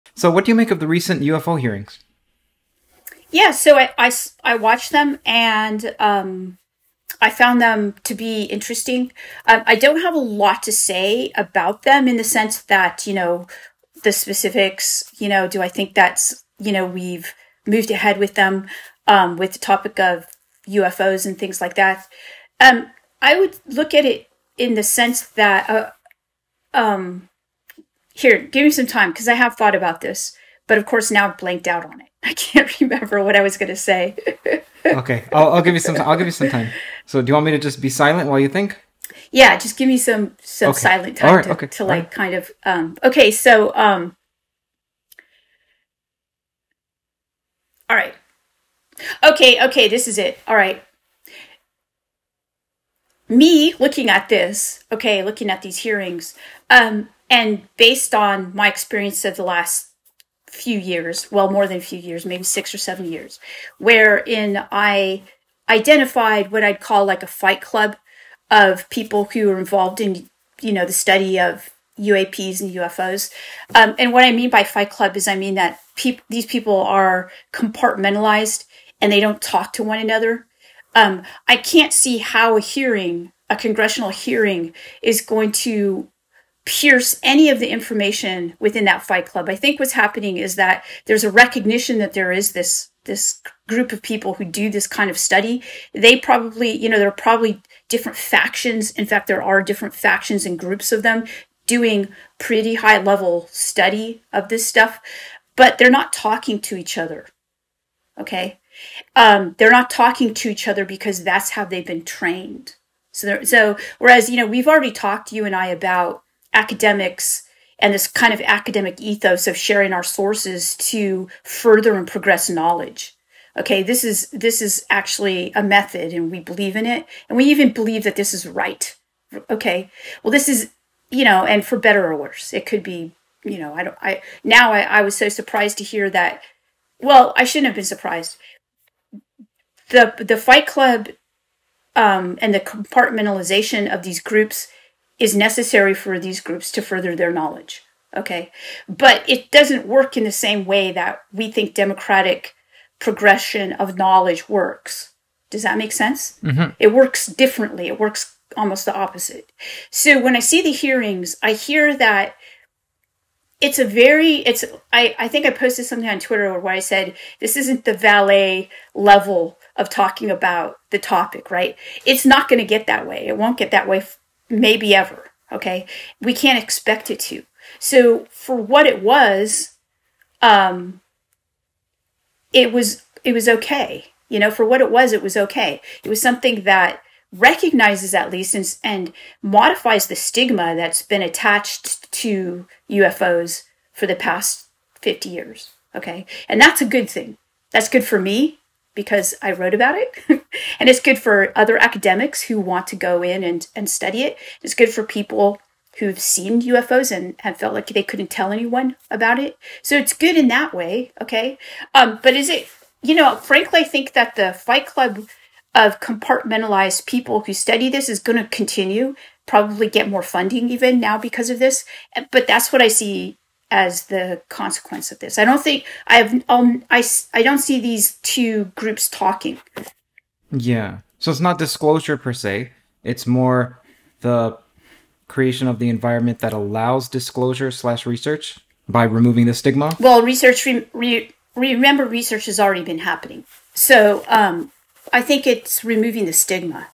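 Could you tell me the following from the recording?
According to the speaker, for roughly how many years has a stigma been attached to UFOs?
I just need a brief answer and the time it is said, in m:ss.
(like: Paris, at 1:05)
50 years, at 3:15.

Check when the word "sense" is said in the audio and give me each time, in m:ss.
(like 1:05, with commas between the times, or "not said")
0:12, 0:24, 2:35.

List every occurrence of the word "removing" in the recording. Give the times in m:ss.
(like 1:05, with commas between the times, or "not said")
3:59, 4:05.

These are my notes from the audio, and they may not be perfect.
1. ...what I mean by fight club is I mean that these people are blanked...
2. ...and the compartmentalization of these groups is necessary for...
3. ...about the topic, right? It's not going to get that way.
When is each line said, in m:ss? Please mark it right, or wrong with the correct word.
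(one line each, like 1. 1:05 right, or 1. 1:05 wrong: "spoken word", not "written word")
1. 1:14 wrong: "compartmentalized", not "blanked"
2. 2:22 right
3. 2:50 right.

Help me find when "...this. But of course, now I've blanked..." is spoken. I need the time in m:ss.
0:30.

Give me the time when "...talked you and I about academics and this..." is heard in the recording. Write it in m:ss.
1:54.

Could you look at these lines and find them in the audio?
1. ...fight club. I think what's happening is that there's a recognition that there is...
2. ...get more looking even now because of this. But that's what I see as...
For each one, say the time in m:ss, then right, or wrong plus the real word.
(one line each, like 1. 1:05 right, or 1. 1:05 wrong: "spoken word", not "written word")
1. 1:29 right
2. 3:39 wrong: "funding", not "looking".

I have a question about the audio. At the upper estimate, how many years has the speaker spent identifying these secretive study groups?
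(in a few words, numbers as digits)
7.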